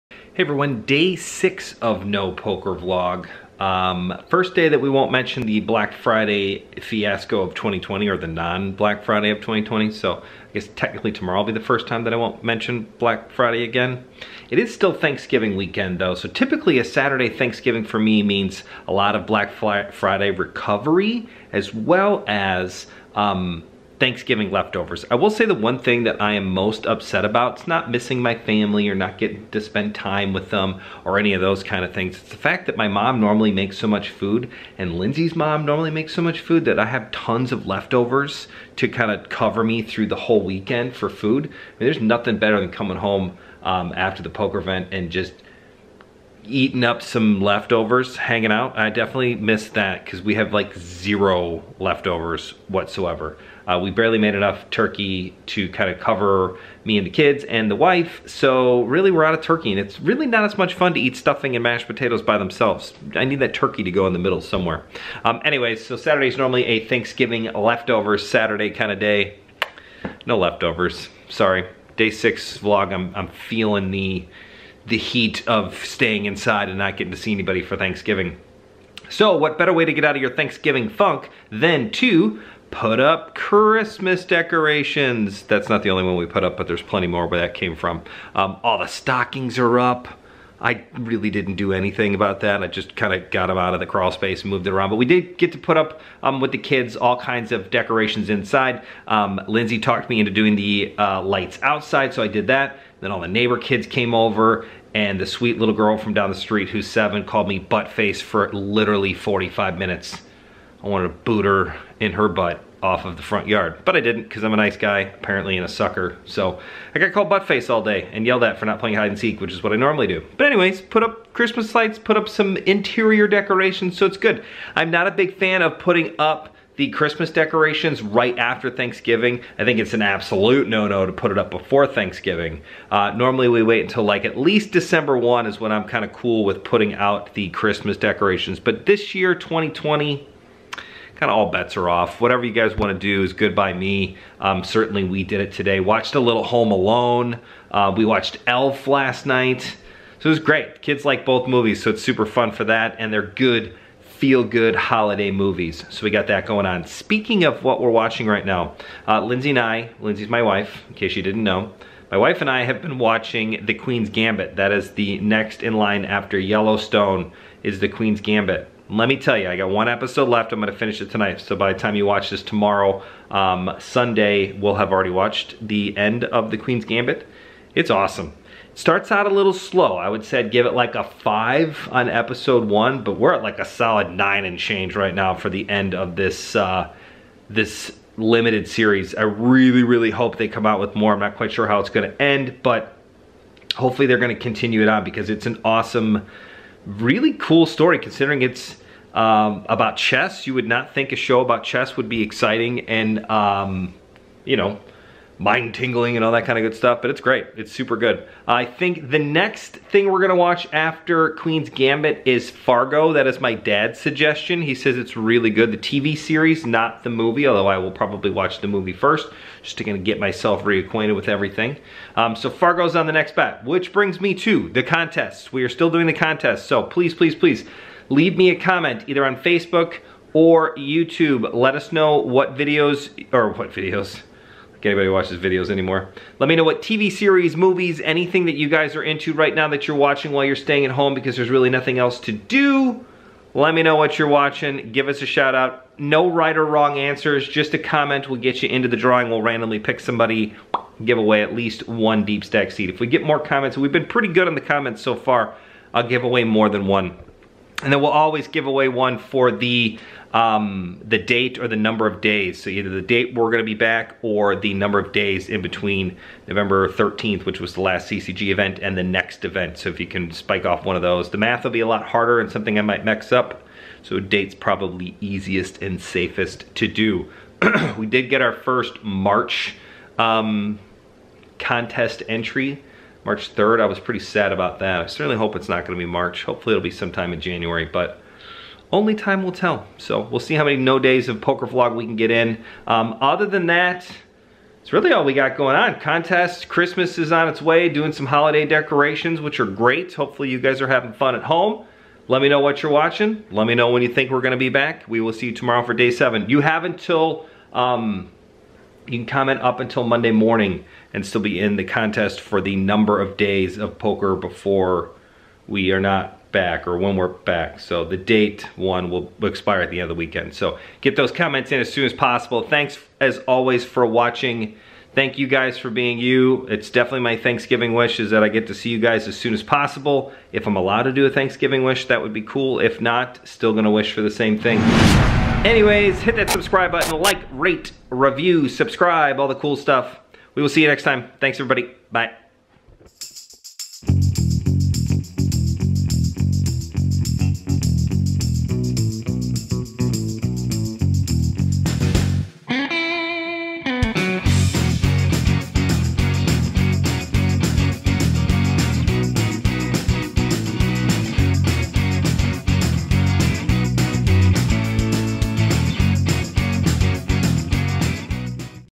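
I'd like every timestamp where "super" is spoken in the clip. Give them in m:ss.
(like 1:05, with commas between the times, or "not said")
2:32, 3:27.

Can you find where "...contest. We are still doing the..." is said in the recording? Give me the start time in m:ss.
3:44.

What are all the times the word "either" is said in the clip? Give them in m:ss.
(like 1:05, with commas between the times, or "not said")
3:49, 4:22.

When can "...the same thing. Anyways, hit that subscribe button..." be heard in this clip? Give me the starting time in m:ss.
5:34.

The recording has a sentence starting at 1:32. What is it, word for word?
I just kind of got them out of the crawl space and moved it around.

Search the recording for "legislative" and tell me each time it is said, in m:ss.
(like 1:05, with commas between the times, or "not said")
not said.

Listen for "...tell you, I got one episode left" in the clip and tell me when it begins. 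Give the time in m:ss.
2:49.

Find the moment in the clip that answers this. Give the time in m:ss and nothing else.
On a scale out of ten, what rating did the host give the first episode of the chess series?
3:00.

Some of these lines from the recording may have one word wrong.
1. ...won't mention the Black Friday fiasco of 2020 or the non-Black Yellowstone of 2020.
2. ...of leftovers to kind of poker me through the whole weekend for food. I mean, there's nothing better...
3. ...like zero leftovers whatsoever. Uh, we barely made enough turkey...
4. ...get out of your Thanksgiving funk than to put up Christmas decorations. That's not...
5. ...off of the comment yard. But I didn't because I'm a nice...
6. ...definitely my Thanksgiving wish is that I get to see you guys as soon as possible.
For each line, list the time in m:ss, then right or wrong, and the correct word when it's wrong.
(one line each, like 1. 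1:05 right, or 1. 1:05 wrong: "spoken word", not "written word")
1. 0:04 wrong: "Friday", not "Yellowstone"
2. 0:37 wrong: "cover", not "poker"
3. 0:50 right
4. 1:19 right
5. 1:52 wrong: "front", not "comment"
6. 5:26 right.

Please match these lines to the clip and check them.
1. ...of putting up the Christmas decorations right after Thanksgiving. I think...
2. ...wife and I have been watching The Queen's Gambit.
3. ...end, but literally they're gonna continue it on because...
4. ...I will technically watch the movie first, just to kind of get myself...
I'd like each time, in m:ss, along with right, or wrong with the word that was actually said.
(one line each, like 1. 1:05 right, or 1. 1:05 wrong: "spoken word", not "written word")
1. 2:05 right
2. 2:42 right
3. 3:12 wrong: "hopefully", not "literally"
4. 3:37 wrong: "probably", not "technically".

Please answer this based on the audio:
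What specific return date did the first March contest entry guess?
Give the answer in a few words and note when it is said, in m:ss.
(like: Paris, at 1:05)
March 3rd, at 4:43.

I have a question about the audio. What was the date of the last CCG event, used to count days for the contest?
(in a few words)
November 13th.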